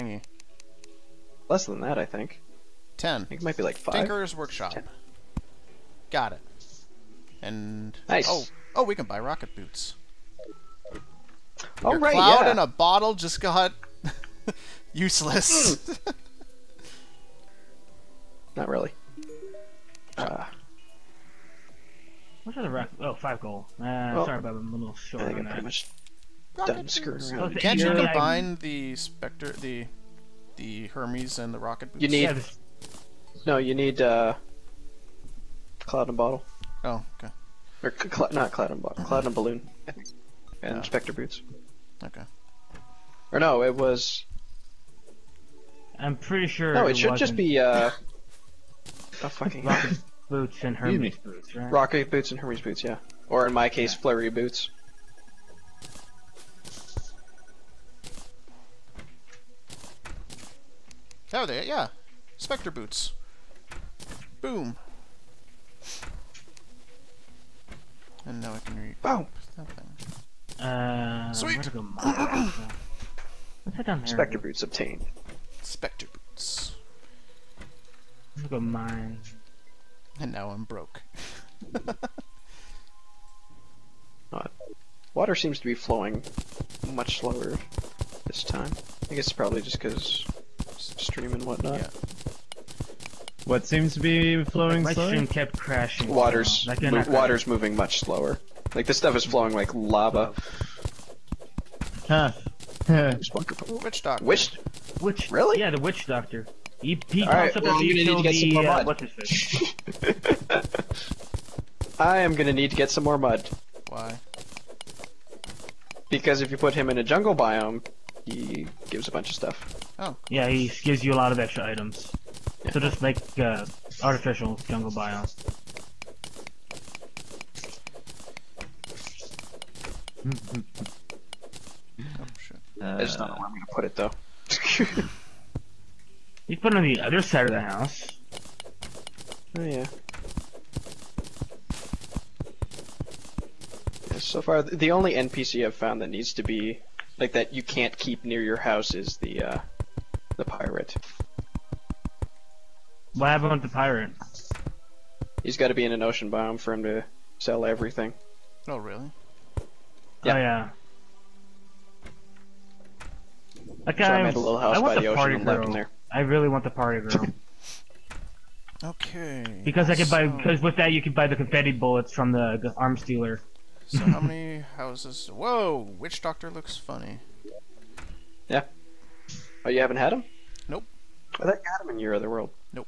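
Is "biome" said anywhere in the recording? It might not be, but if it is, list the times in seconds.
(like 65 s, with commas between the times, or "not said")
117 s, 124 s, 156 s.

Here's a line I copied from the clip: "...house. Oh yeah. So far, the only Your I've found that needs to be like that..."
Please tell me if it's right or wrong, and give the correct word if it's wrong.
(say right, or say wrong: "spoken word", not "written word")
wrong: "NPC", not "Your".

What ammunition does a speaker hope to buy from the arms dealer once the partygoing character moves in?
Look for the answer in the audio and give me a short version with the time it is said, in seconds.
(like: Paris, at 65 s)
confetti bullets, at 171 s.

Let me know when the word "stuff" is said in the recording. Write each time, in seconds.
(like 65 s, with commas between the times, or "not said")
98 s, 119 s.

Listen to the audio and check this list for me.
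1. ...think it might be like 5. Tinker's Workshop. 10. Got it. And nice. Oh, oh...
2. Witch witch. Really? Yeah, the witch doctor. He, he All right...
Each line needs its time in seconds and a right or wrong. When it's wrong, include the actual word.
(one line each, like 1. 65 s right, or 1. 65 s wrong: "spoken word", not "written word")
1. 3 s right
2. 104 s right.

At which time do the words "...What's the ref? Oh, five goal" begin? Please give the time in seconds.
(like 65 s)
22 s.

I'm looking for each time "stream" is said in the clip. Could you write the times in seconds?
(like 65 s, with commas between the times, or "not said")
90 s, 95 s.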